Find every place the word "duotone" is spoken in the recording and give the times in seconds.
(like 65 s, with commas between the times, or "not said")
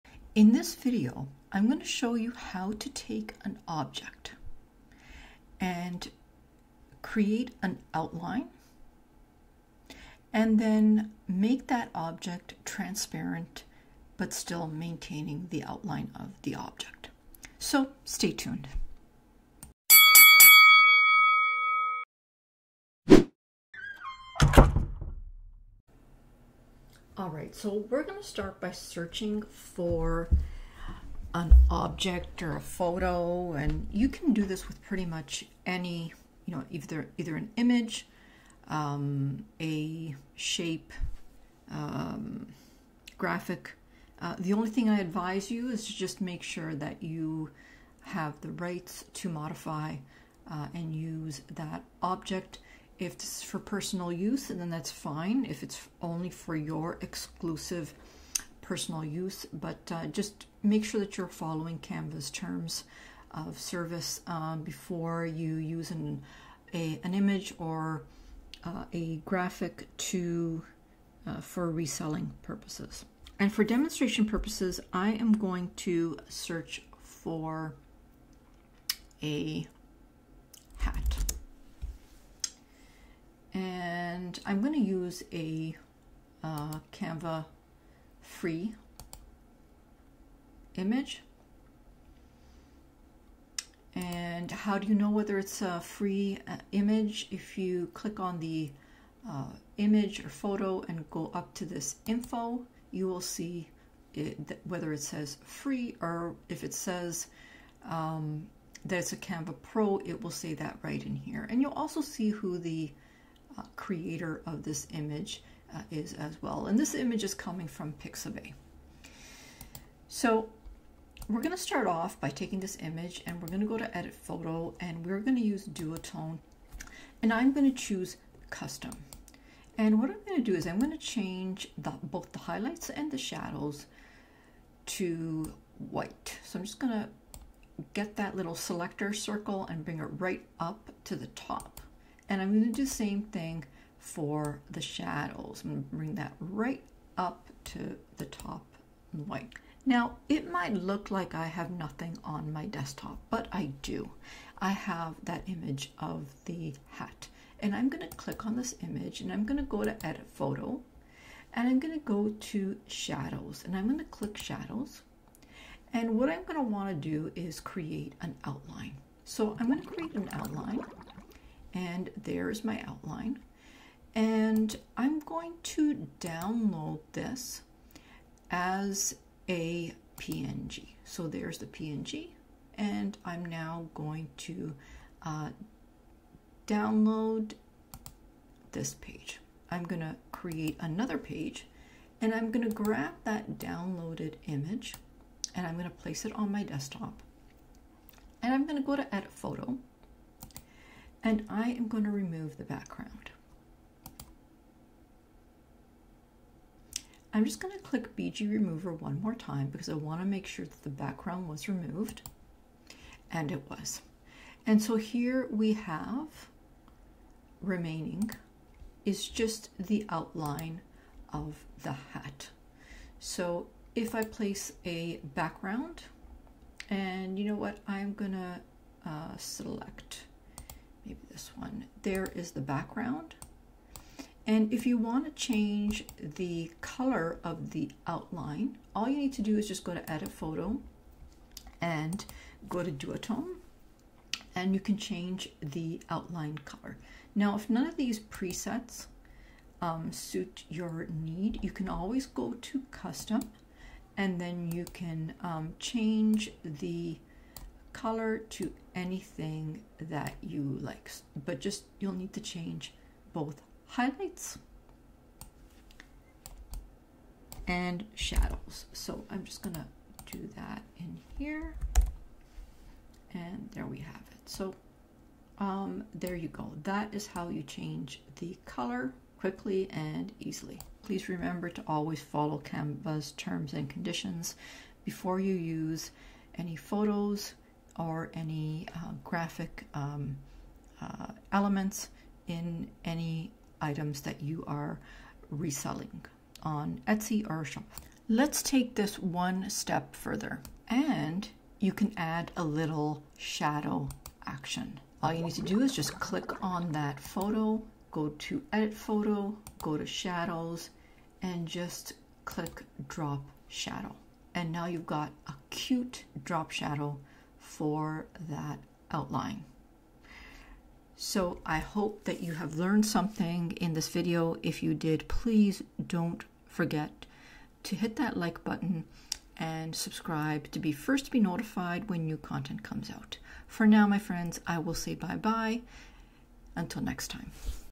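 125 s, 242 s.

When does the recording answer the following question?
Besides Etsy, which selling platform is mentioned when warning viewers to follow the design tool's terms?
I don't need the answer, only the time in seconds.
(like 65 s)
297 s.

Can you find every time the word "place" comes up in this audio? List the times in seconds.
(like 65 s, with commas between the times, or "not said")
195 s, 224 s.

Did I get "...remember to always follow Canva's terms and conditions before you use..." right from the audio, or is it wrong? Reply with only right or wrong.
right.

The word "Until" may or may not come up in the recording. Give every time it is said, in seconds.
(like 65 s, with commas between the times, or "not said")
336 s.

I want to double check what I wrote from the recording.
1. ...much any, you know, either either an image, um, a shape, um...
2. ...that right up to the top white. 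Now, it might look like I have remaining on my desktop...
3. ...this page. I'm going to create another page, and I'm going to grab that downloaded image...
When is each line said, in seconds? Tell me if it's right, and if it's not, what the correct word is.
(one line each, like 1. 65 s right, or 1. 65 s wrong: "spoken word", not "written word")
1. 35 s right
2. 146 s wrong: "nothing", not "remaining"
3. 188 s right.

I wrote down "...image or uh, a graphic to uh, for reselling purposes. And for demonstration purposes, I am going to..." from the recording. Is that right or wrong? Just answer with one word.
right.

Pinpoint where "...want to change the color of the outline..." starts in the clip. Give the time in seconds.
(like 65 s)
234 s.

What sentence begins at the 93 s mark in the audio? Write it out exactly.
And how do you know whether it's a free uh, image?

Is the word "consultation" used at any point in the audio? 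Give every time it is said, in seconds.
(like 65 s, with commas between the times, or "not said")
not said.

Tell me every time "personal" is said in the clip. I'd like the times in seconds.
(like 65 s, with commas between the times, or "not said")
53 s, 58 s.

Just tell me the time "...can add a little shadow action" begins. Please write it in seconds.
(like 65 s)
301 s.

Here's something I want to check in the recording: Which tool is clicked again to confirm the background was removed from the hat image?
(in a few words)
BG Remover.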